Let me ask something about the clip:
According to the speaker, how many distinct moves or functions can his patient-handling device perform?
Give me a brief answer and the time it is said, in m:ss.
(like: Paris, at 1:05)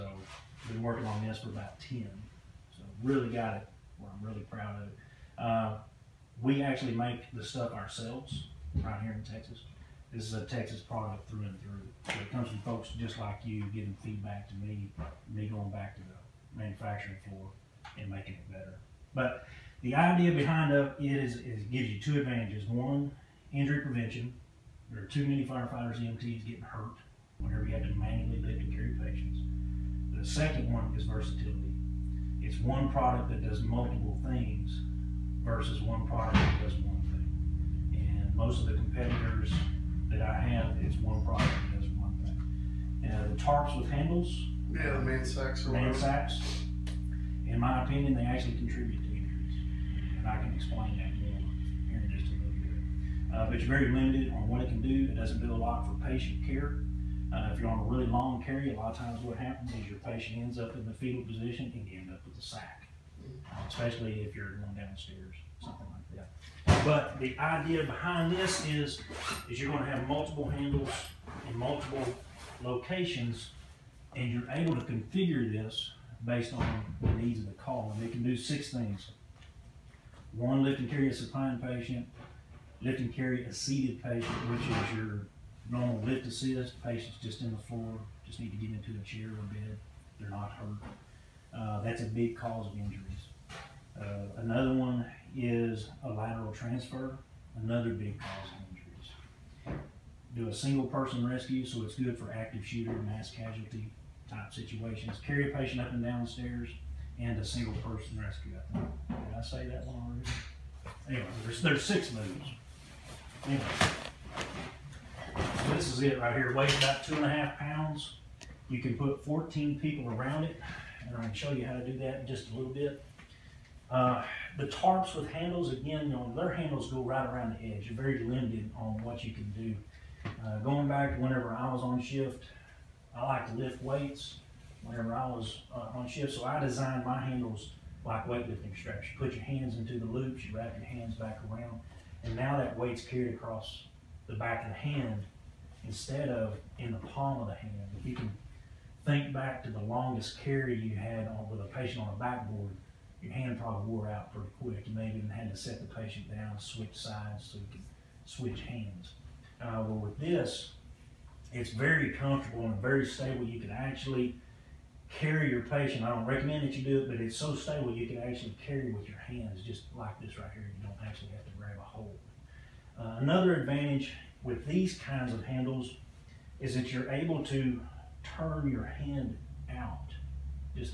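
6, at 1:18.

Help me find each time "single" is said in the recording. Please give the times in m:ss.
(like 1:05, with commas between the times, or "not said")
1:40, 1:47.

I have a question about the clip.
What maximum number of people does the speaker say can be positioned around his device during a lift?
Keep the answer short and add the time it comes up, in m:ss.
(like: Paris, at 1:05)
14, at 1:59.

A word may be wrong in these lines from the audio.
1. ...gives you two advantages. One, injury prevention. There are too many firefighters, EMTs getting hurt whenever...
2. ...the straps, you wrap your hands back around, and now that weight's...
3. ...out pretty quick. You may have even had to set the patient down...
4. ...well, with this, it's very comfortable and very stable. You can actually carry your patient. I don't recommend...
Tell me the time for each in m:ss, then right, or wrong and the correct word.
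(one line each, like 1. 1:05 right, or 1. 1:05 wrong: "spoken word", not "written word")
1. 0:21 right
2. 2:19 wrong: "loops", not "straps"
3. 2:34 right
4. 2:39 right.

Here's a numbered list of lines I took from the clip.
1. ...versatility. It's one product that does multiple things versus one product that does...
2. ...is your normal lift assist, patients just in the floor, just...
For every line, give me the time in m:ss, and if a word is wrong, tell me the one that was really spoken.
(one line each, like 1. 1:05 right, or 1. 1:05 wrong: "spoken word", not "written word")
1. 0:31 right
2. 1:24 right.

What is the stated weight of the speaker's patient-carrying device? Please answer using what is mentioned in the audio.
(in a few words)
2.5 pounds.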